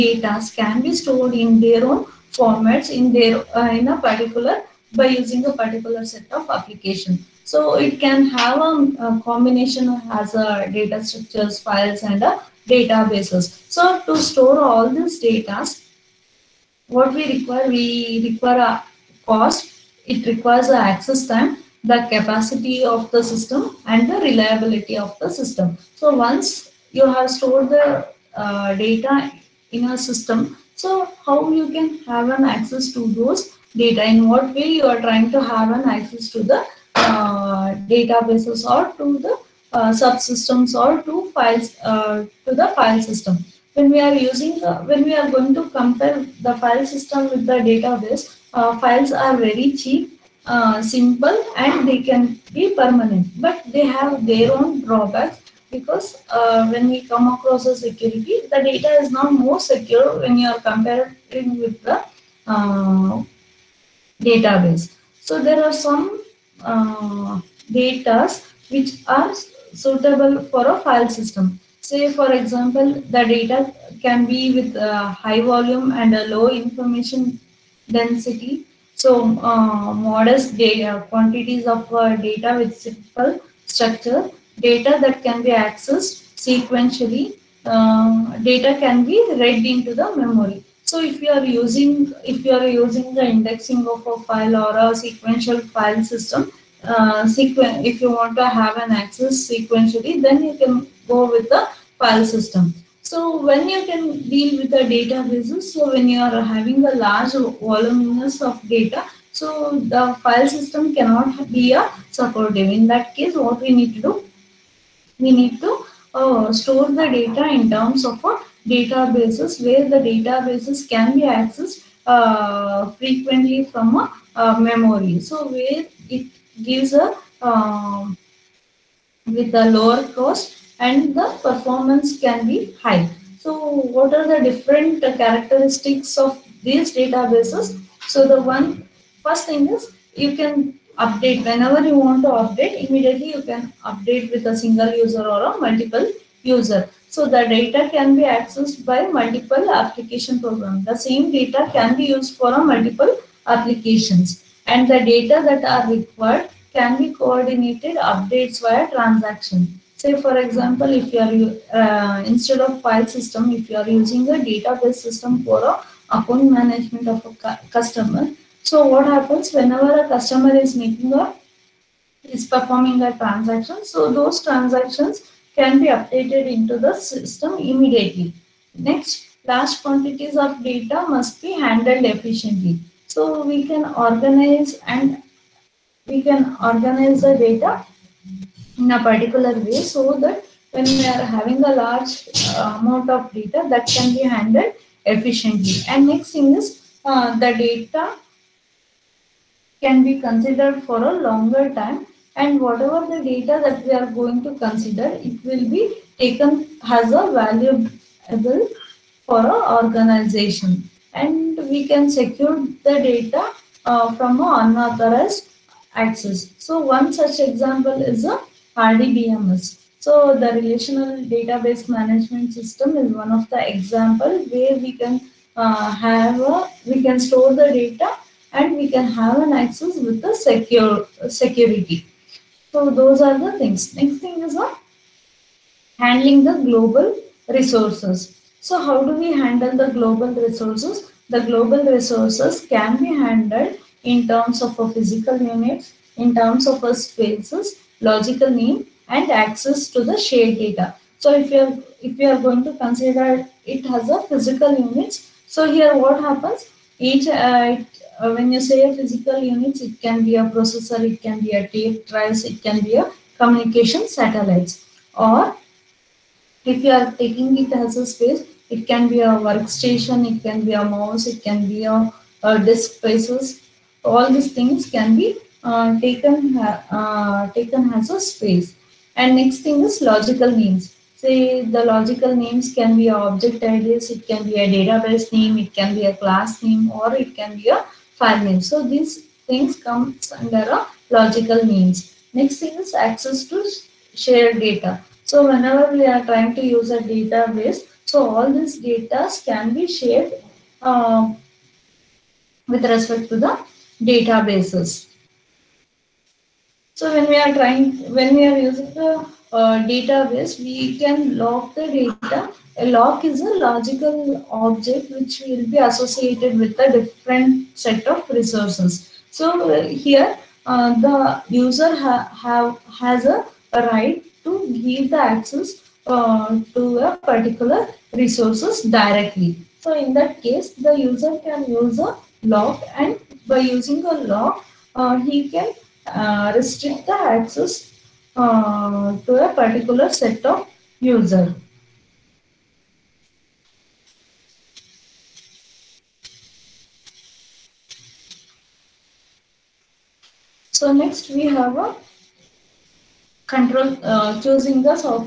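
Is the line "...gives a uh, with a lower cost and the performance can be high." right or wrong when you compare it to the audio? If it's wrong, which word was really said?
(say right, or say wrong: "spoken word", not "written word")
right.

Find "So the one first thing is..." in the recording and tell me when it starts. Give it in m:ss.
2:18.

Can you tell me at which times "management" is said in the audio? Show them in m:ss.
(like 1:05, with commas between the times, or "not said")
2:46, 3:41.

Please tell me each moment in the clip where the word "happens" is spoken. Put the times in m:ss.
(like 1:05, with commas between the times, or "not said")
2:49, 4:16.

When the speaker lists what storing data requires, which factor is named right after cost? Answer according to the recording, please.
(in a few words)
access time.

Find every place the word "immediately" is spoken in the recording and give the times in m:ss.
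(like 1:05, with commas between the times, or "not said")
2:22, 2:57.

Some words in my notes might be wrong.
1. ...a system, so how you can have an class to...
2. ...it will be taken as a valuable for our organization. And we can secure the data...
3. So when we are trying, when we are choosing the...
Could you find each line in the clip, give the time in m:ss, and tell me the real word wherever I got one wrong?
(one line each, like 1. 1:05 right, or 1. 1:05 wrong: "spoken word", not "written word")
1. 0:29 wrong: "access", not "class"
2. 3:25 right
3. 5:06 wrong: "using", not "choosing".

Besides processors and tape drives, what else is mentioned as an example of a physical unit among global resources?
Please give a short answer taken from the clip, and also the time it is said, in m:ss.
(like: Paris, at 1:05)
communication satellites, at 4:23.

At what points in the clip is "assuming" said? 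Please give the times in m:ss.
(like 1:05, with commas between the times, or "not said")
not said.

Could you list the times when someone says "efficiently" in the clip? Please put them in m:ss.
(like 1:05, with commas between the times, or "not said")
3:02, 3:15.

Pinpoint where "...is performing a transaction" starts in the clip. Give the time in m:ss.
2:52.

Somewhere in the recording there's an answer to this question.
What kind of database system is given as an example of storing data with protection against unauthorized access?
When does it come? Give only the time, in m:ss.
3:38.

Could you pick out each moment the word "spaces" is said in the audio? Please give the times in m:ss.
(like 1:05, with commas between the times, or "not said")
4:06, 4:28, 4:32, 4:38.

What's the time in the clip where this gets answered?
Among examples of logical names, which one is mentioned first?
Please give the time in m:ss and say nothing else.
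4:43.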